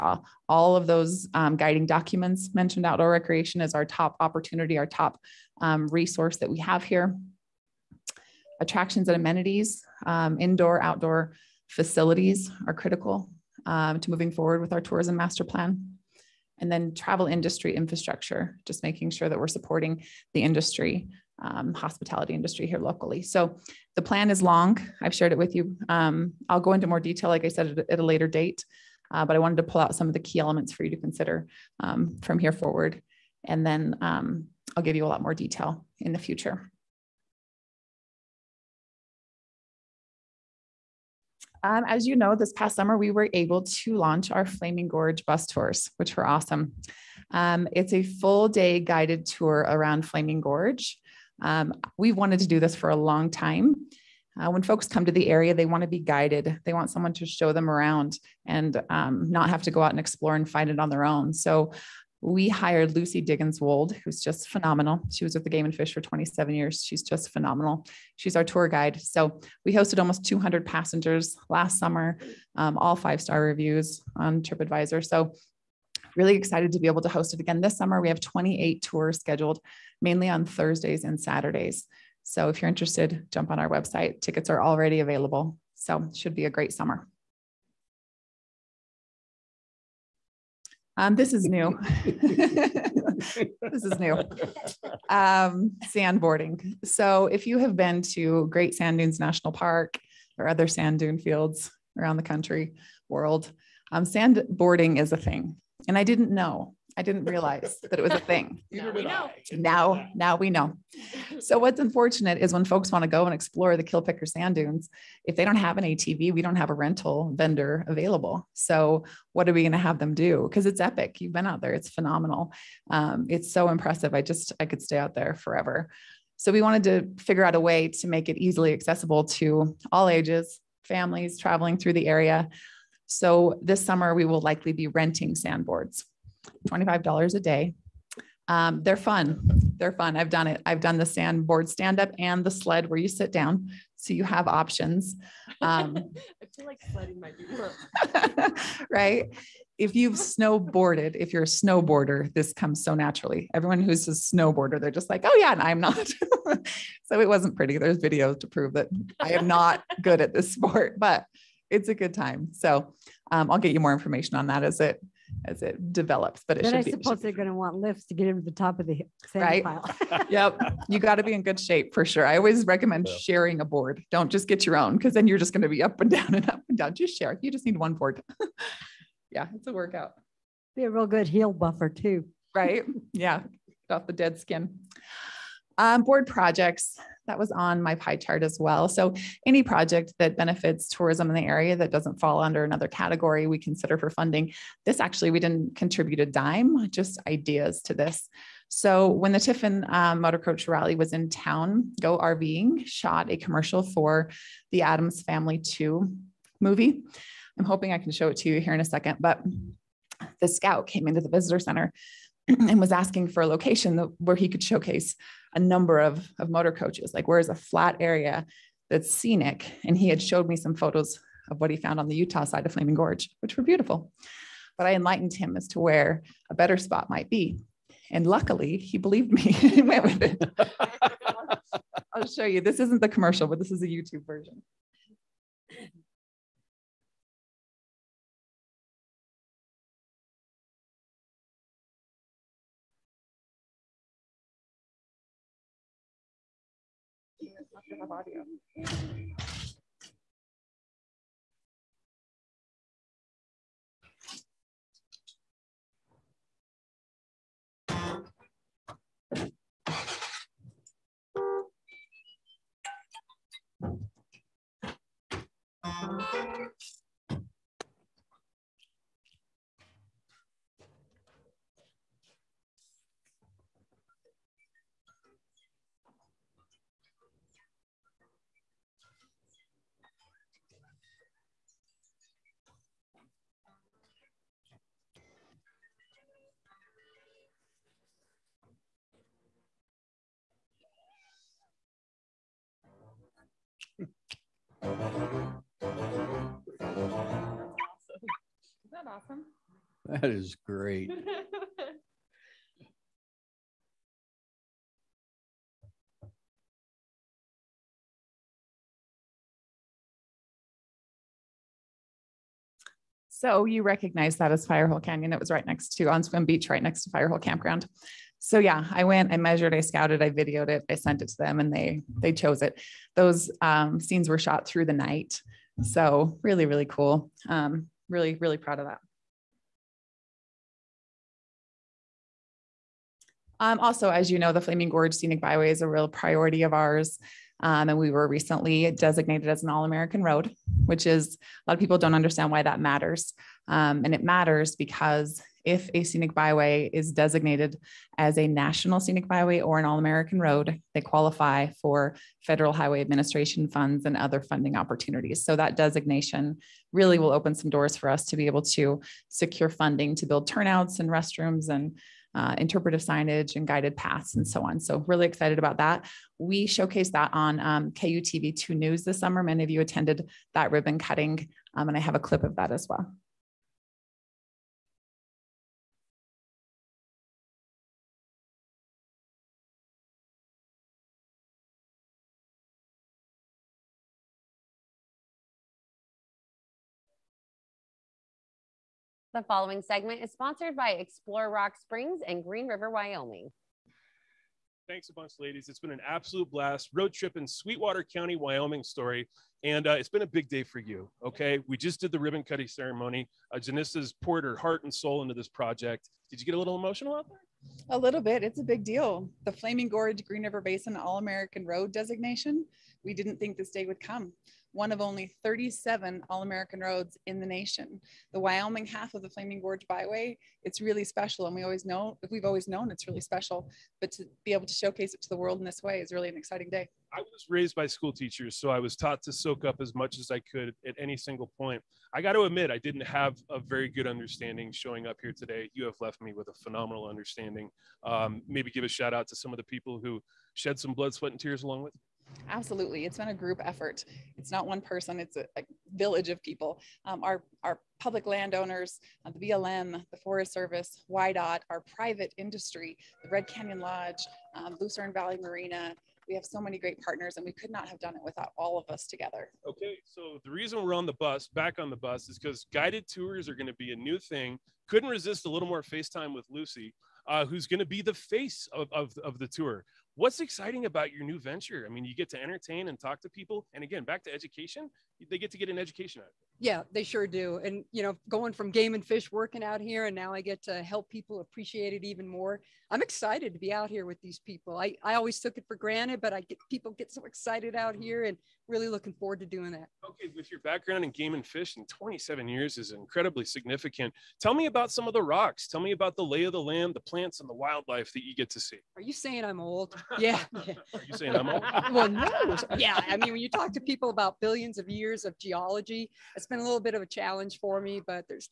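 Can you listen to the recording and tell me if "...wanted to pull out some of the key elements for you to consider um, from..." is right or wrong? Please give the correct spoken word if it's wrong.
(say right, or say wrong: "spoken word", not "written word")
right.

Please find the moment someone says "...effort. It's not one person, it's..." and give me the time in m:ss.
7:23.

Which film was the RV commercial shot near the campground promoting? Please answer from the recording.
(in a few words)
Addams Family 2.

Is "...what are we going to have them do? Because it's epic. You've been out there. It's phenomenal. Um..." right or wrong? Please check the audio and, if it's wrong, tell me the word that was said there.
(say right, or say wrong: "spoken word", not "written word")
right.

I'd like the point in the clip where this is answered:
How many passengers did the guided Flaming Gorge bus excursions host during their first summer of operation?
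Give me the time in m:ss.
1:09.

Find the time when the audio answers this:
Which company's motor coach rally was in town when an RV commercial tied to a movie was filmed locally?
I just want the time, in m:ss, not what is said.
3:19.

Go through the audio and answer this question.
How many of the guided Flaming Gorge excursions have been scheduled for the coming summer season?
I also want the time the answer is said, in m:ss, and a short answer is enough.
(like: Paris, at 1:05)
28, at 1:18.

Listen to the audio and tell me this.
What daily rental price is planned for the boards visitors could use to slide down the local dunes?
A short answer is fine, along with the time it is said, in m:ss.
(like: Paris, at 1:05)
$25, at 2:16.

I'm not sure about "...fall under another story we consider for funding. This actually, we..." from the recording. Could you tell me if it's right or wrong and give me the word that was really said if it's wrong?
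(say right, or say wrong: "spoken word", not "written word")
wrong: "category", not "story".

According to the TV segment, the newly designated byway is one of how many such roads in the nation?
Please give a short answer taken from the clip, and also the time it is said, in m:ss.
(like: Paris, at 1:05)
37, at 6:55.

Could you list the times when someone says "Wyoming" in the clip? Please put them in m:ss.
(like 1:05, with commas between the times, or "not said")
6:32, 6:38, 6:58.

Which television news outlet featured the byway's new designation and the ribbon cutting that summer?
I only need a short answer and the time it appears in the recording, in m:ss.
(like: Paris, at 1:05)
KUTV2 News, at 6:07.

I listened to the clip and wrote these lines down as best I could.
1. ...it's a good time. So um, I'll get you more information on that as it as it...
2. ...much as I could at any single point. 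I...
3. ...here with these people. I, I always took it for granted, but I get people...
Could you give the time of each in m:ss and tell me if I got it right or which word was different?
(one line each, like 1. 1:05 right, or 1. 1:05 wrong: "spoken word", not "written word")
1. 2:41 right
2. 7:09 right
3. 8:03 right.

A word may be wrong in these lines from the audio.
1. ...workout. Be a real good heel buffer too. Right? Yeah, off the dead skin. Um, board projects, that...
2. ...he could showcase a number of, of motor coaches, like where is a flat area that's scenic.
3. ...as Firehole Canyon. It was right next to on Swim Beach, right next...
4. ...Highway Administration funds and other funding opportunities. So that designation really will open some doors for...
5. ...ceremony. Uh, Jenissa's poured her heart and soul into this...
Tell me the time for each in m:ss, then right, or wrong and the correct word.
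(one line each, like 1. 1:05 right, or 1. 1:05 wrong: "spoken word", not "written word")
1. 2:59 right
2. 3:34 right
3. 5:14 right
4. 5:52 right
5. 6:42 right.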